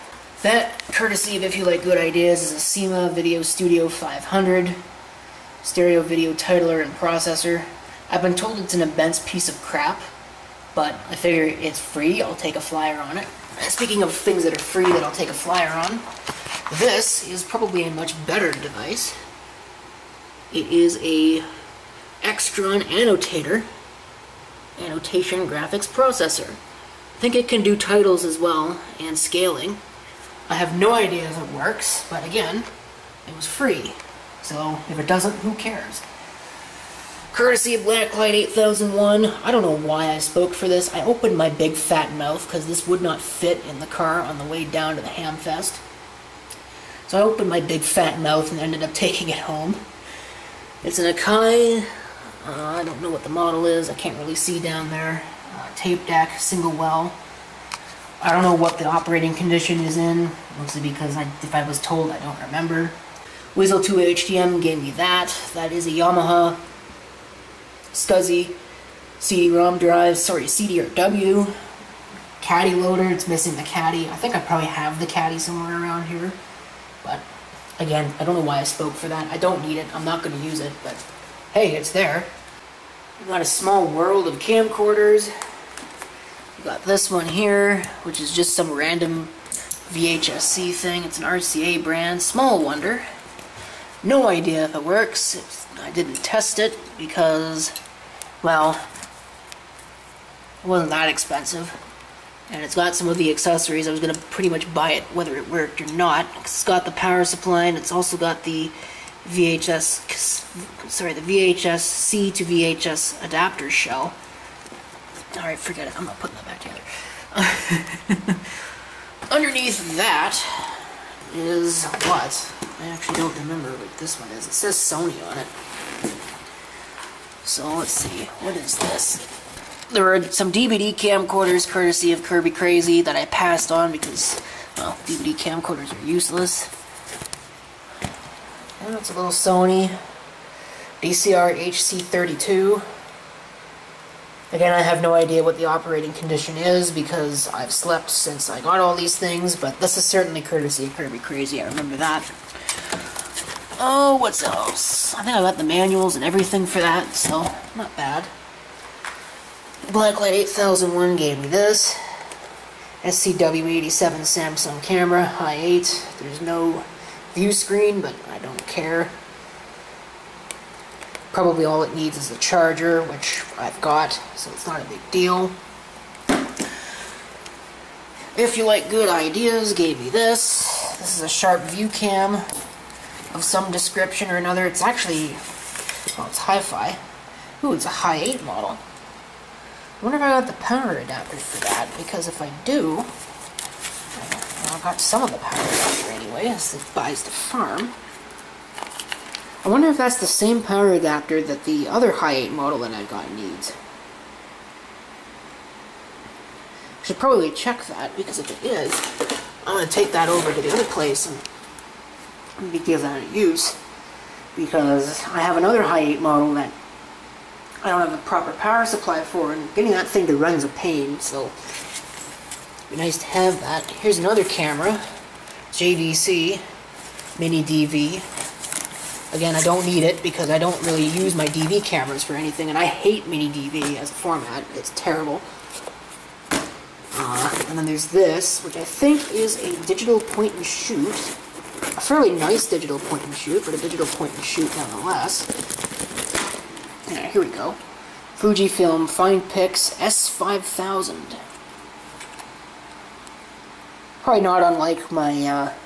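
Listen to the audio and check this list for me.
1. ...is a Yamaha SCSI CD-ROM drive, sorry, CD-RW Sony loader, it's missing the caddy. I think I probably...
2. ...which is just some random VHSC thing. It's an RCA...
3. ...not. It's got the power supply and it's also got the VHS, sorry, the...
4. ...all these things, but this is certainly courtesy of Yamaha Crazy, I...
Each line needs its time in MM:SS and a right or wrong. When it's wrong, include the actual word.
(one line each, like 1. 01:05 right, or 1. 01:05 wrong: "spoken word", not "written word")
1. 01:05 wrong: "Caddy", not "Sony"
2. 01:28 right
3. 01:45 right
4. 02:28 wrong: "Kirby", not "Yamaha".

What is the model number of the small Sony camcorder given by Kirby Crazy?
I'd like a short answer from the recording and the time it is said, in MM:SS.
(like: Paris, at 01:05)
DCR HC32, at 02:21.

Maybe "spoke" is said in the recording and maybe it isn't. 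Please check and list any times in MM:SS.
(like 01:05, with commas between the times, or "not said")
00:40, 01:18.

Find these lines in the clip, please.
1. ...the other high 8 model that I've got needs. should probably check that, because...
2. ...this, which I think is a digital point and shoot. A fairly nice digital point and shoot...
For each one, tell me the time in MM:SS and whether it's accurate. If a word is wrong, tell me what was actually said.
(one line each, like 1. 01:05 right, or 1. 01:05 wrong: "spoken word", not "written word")
1. 03:21 right
2. 03:58 right.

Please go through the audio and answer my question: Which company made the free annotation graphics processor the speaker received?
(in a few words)
Extron.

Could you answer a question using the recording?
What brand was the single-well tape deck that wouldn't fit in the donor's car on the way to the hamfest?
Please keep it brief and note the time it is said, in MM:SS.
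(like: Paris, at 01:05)
Akai, at 00:51.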